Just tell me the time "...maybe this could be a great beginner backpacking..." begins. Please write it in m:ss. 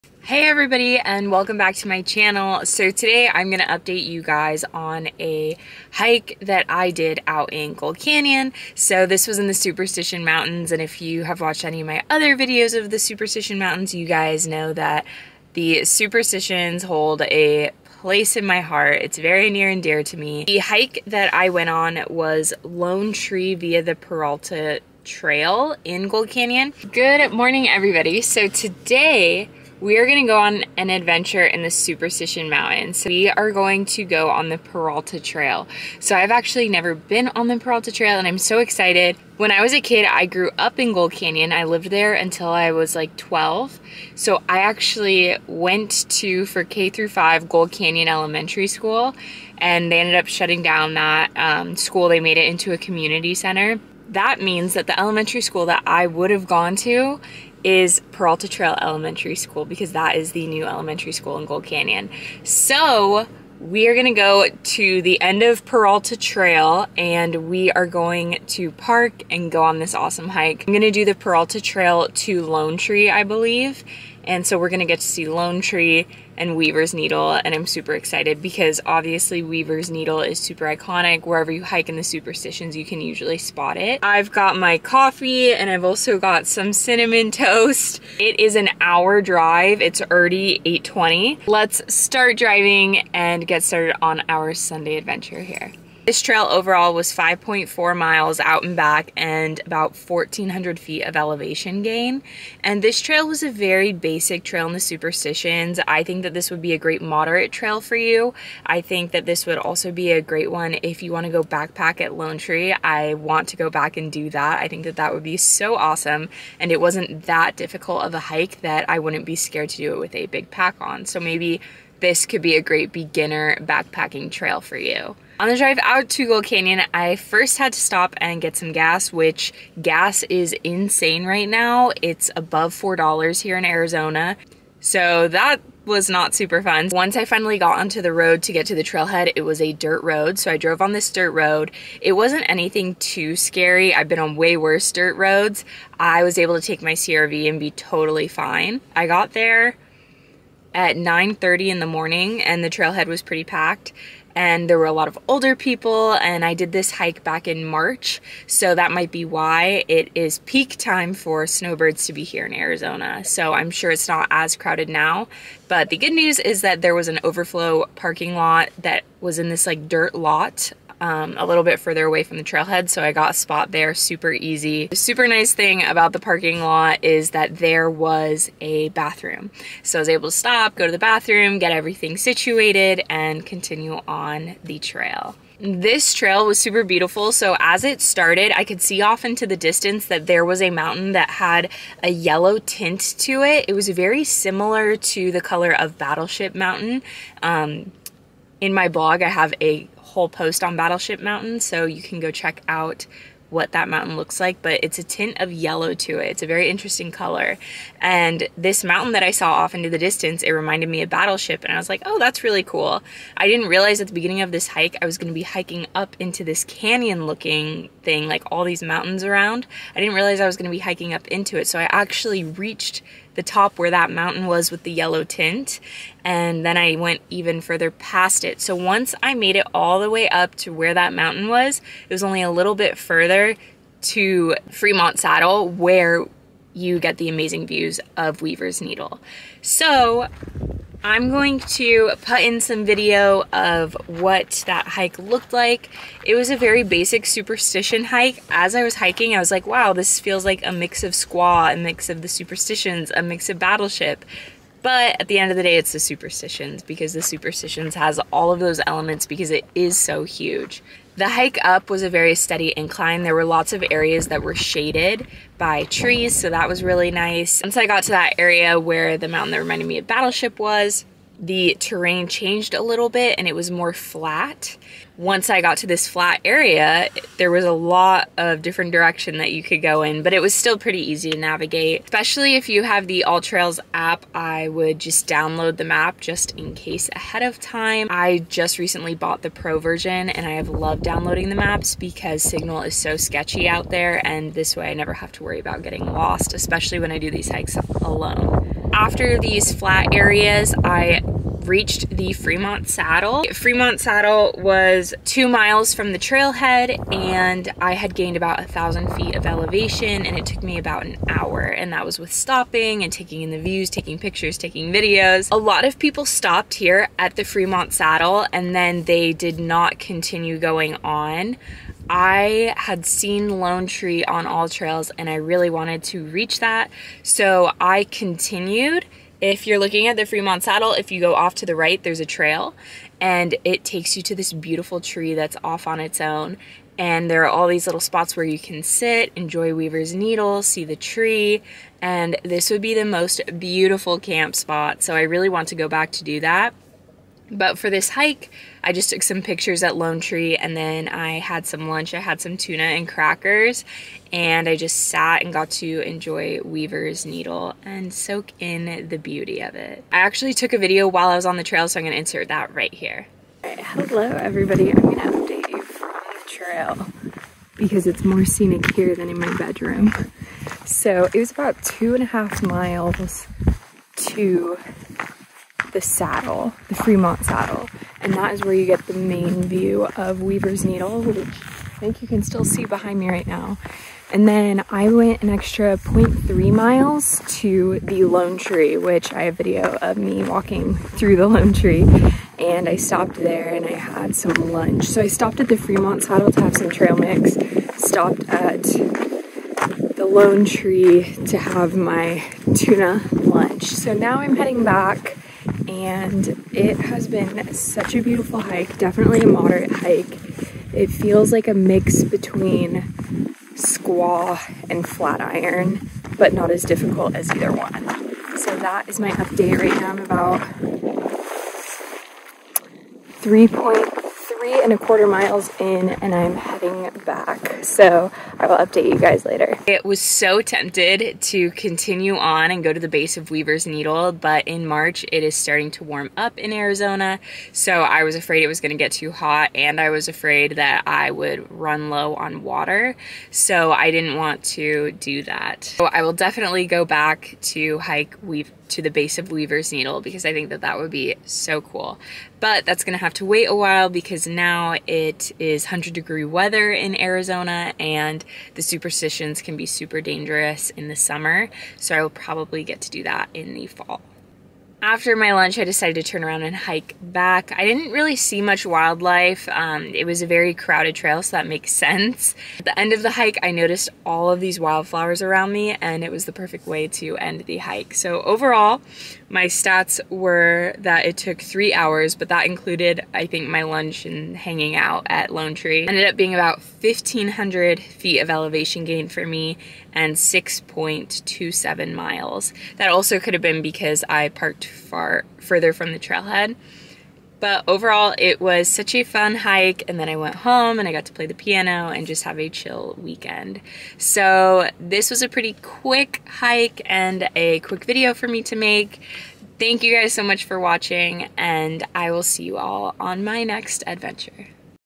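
2:01.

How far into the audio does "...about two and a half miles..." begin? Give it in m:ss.
6:11.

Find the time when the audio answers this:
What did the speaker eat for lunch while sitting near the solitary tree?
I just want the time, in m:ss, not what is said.
5:52.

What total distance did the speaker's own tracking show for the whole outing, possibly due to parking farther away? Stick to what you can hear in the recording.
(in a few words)
6.27 miles.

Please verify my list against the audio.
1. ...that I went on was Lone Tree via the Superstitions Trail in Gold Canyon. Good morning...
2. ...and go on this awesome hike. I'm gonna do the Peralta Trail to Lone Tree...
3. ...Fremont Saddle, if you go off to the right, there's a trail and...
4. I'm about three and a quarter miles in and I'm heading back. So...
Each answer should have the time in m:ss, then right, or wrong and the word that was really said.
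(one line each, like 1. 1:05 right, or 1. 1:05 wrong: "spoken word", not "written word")
1. 0:21 wrong: "Peralta", not "Superstitions"
2. 1:09 right
3. 5:30 right
4. 7:00 right.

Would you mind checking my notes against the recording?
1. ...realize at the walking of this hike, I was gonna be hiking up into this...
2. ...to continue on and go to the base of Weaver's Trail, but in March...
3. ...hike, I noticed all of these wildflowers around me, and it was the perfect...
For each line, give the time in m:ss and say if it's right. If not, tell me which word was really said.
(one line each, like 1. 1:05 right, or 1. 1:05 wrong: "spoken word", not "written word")
1. 3:33 wrong: "beginning", not "walking"
2. 7:11 wrong: "Needle", not "Trail"
3. 7:53 right.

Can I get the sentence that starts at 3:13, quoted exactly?
It was very similar to the color of Battleship Mountain.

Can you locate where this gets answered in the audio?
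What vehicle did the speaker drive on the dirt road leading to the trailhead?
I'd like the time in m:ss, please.
2:26.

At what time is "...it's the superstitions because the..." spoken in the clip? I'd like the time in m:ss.
4:15.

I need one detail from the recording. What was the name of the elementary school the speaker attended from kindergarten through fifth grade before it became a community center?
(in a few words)
Gold Canyon Elementary School.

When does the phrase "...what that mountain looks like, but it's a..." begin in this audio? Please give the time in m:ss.
3:23.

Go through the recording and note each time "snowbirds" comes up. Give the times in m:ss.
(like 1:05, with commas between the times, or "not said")
2:41.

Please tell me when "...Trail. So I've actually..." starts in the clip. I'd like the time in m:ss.
0:35.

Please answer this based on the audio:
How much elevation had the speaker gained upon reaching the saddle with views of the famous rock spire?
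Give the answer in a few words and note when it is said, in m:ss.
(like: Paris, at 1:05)
about 1,000 feet, at 5:08.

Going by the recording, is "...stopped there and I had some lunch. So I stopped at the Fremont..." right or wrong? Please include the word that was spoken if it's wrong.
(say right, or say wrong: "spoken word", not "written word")
right.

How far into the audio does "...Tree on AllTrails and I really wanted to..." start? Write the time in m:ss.
5:23.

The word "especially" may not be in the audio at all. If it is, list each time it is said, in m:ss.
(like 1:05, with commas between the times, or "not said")
4:42, 4:56.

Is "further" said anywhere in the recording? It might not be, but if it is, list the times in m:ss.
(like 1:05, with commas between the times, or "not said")
2:51, 3:47, 3:52, 8:15.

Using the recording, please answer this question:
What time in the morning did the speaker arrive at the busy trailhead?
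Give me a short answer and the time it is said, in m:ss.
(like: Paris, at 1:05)
9:30, at 2:30.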